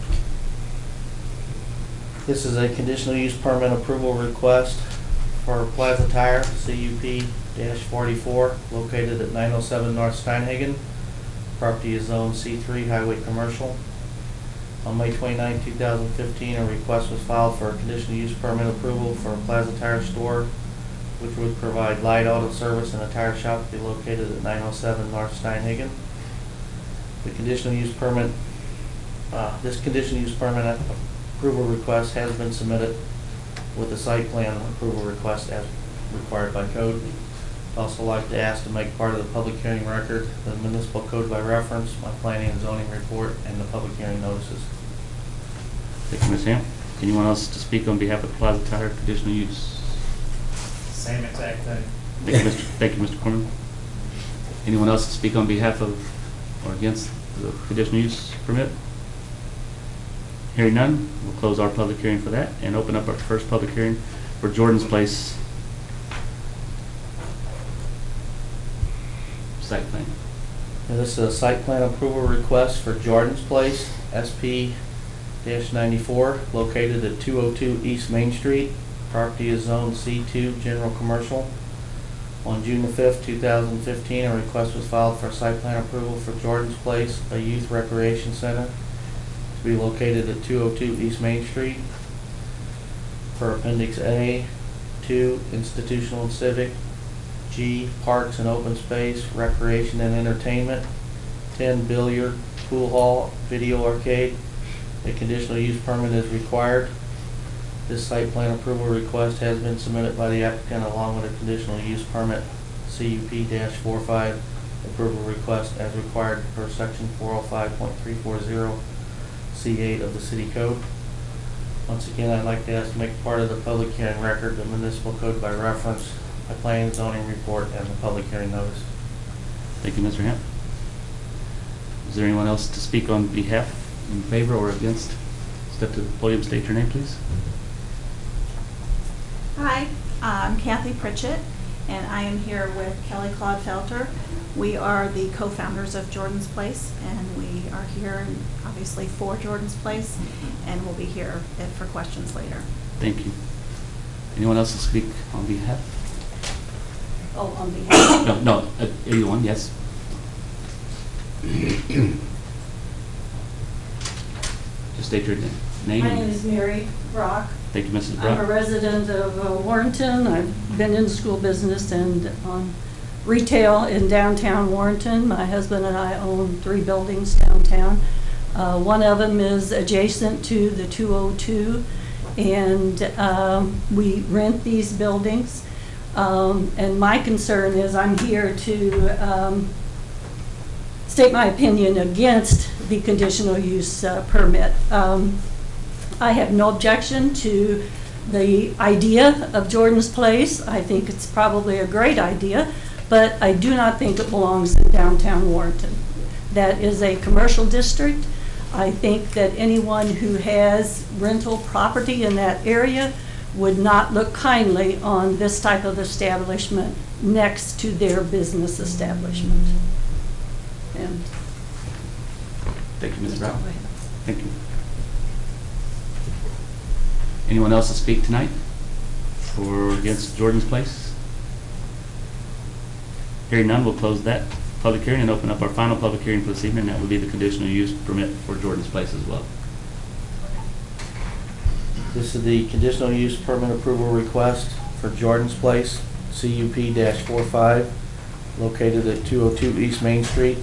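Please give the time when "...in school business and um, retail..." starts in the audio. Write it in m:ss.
2:50.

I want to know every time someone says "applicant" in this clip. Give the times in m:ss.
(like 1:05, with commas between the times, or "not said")
1:50.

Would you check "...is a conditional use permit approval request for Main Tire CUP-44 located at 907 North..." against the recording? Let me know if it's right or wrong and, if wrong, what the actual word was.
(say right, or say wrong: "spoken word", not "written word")
wrong: "Plaza", not "Main".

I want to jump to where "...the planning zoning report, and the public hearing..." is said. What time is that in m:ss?
2:06.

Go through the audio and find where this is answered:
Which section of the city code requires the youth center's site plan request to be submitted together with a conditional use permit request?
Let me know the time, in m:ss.
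1:57.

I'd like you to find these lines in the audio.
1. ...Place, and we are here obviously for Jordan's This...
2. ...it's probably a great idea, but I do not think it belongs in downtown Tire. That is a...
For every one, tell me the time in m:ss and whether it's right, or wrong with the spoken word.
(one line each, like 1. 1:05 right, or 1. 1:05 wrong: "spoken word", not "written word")
1. 2:26 wrong: "Place", not "This"
2. 3:21 wrong: "Warrenton", not "Tire".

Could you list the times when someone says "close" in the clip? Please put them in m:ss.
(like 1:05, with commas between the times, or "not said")
1:01, 3:53.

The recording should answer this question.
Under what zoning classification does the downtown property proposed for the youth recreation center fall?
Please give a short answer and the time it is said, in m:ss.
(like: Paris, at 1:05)
C2, General Commercial, at 1:19.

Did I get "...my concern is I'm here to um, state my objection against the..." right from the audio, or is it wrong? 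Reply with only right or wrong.
wrong.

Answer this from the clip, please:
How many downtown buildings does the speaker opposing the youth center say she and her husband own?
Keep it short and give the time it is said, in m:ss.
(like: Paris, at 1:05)
3, at 2:56.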